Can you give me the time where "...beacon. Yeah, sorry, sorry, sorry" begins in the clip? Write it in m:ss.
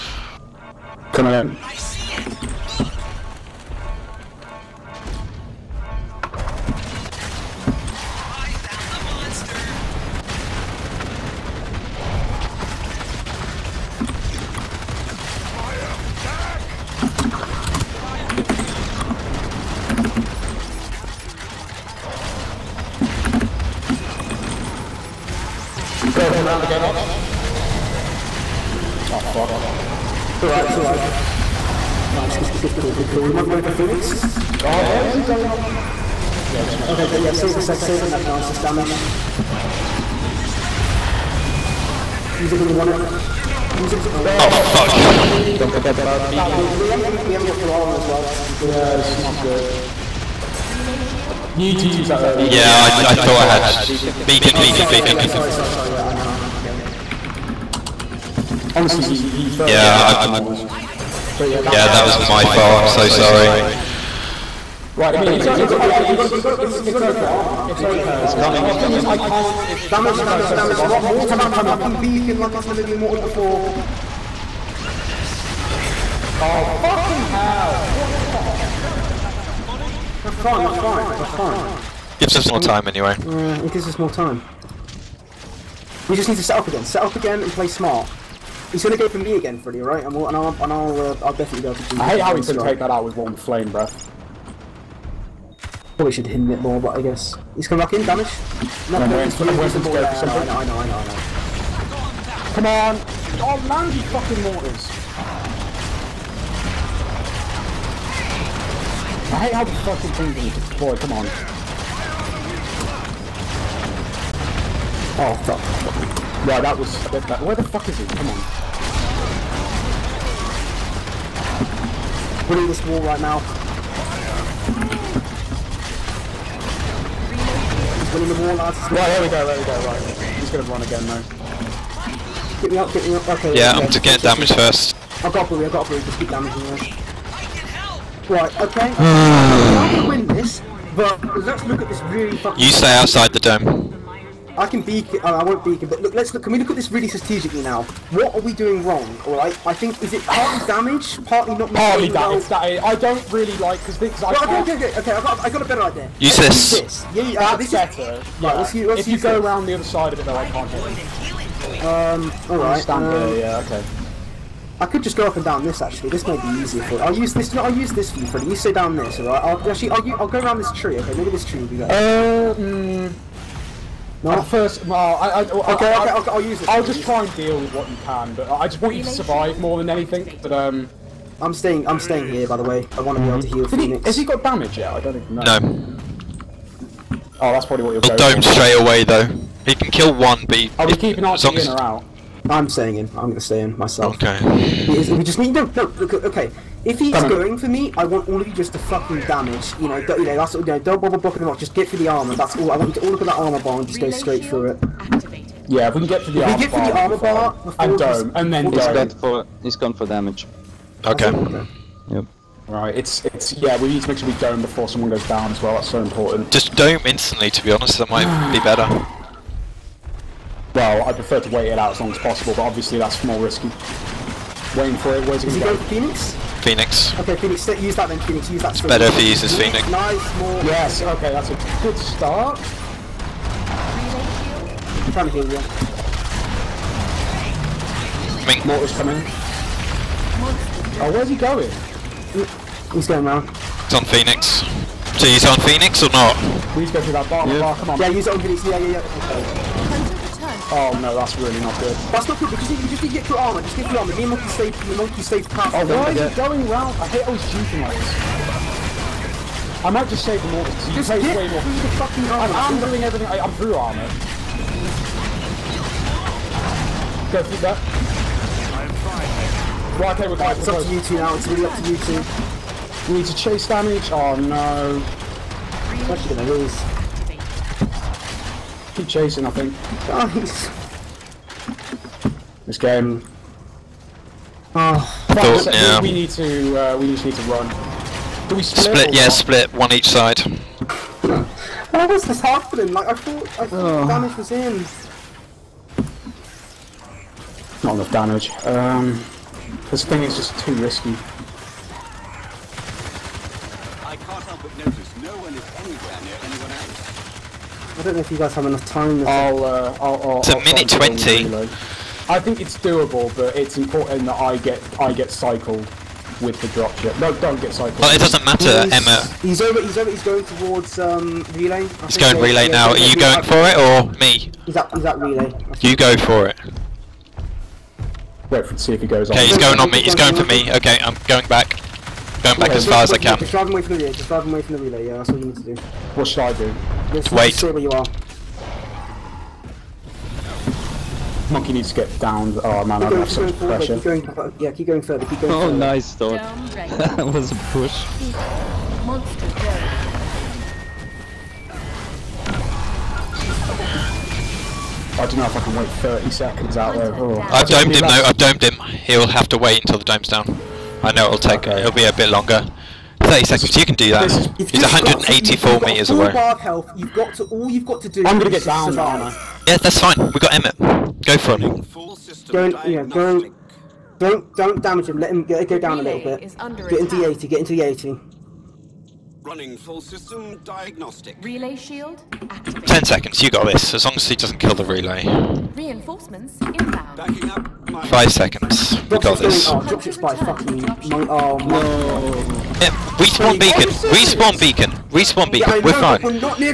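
0:55.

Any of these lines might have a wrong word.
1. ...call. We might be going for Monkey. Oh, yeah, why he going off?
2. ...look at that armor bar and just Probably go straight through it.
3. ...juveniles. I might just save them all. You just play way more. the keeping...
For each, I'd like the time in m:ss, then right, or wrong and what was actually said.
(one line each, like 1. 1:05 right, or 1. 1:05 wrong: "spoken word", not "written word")
1. 0:33 wrong: "Phoenix", not "Monkey"
2. 3:23 wrong: "Relay", not "Probably"
3. 4:17 wrong: "fucking", not "keeping".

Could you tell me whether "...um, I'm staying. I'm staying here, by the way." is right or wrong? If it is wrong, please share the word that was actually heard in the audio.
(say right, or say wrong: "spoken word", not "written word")
right.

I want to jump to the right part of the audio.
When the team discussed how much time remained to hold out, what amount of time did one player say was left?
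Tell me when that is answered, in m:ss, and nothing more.
5:10.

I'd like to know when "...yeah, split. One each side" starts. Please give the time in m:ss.
4:49.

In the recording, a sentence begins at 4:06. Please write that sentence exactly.
Please go through that bar, yeah.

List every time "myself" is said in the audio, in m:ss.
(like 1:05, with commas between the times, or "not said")
3:13.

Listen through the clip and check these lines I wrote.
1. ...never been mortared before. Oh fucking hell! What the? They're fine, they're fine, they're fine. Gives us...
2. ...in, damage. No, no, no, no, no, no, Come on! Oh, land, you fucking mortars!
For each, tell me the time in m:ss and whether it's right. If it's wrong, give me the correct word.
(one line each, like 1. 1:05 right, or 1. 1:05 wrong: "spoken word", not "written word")
1. 1:12 right
2. 1:37 right.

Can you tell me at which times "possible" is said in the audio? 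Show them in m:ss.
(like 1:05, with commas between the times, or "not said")
3:42.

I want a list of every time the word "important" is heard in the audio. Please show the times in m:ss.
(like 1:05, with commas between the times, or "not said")
3:36, 5:13.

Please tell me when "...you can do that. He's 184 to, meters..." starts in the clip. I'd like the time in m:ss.
6:03.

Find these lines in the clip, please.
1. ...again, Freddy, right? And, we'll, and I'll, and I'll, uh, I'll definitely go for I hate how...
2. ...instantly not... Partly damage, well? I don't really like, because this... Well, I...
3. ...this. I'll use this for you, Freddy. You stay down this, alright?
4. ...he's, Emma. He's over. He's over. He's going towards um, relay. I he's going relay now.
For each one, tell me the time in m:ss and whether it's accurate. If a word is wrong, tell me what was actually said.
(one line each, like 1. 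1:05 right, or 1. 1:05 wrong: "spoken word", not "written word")
1. 1:29 right
2. 2:31 wrong: "partly", not "instantly"
3. 2:47 right
4. 5:18 right.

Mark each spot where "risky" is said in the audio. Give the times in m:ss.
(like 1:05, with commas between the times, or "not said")
3:43, 5:00.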